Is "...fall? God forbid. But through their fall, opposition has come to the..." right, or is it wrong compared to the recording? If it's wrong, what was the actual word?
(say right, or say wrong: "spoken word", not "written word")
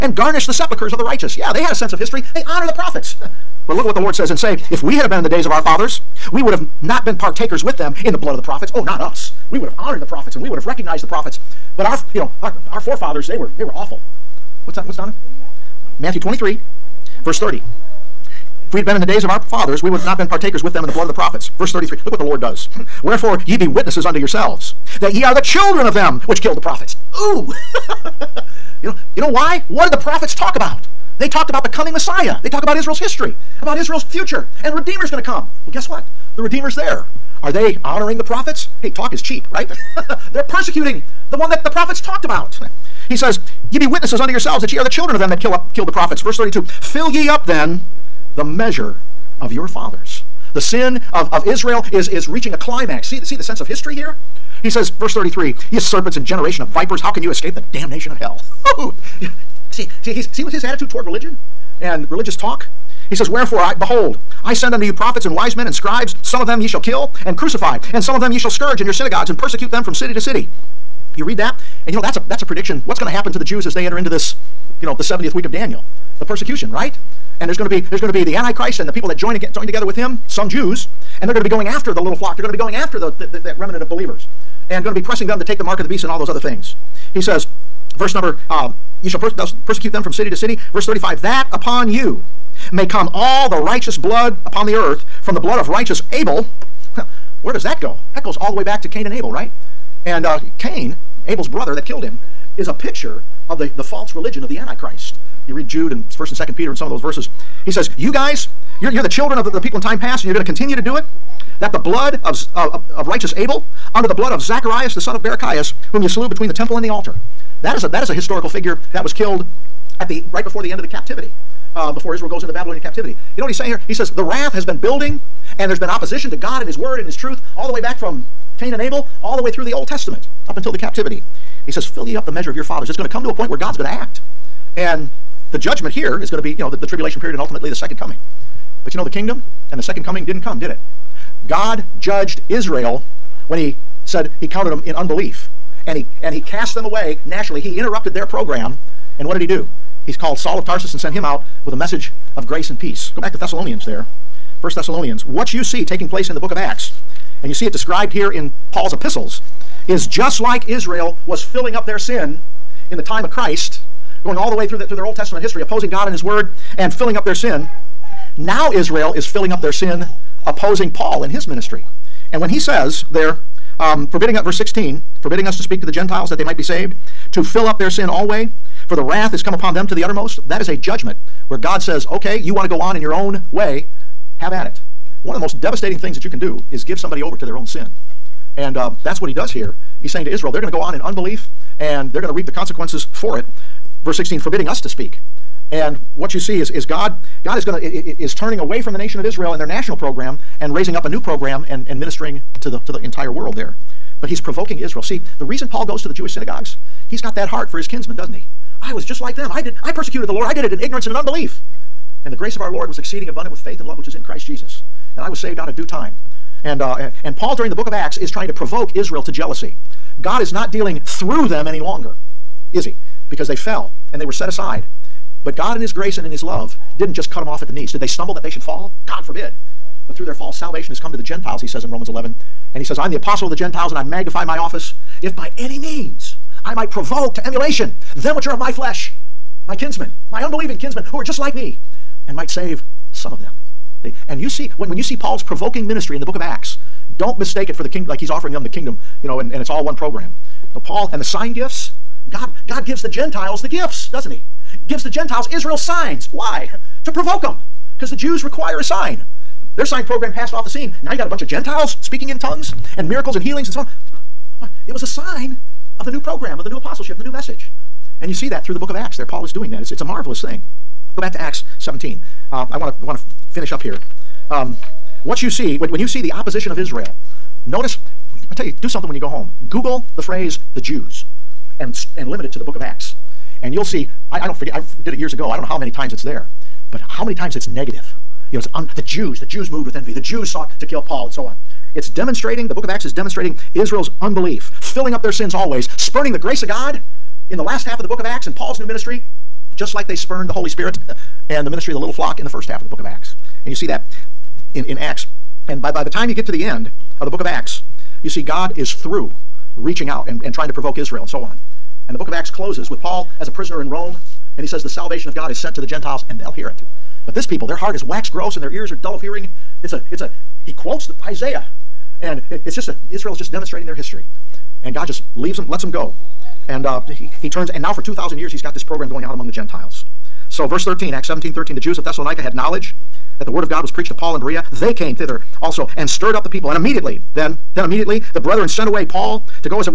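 wrong: "salvation", not "opposition".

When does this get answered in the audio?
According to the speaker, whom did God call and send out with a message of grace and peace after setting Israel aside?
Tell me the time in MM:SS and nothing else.
02:30.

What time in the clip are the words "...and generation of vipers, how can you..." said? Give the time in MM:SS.
00:56.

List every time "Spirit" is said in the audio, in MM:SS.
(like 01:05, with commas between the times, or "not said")
05:00.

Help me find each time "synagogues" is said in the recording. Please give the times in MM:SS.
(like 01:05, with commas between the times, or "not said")
01:08, 03:26.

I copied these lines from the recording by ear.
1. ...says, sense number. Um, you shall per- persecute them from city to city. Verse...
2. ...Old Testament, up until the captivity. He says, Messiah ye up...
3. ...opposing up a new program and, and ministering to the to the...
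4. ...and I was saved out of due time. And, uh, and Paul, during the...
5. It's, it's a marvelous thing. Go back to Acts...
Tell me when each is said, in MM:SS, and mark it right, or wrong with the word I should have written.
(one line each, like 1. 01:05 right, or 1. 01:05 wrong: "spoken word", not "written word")
1. 01:27 wrong: "verse", not "sense"
2. 02:09 wrong: "Fill", not "Messiah"
3. 03:20 wrong: "raising", not "opposing"
4. 03:35 right
5. 04:29 right.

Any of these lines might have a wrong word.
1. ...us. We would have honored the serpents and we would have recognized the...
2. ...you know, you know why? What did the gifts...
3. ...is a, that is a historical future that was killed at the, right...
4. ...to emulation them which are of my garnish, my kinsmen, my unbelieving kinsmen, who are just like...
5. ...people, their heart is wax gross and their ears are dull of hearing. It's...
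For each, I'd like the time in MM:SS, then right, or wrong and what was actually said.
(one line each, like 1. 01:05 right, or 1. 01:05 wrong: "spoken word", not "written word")
1. 00:08 wrong: "prophets", not "serpents"
2. 00:28 wrong: "prophets", not "gifts"
3. 01:57 wrong: "figure", not "future"
4. 03:57 wrong: "flesh", not "garnish"
5. 05:17 right.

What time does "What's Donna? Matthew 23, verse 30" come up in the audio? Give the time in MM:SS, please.
00:14.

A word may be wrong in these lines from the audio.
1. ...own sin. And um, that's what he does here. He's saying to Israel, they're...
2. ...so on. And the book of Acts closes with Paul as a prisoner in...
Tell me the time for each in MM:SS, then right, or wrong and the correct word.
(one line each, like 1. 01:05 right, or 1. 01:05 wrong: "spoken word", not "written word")
1. 03:07 right
2. 05:11 right.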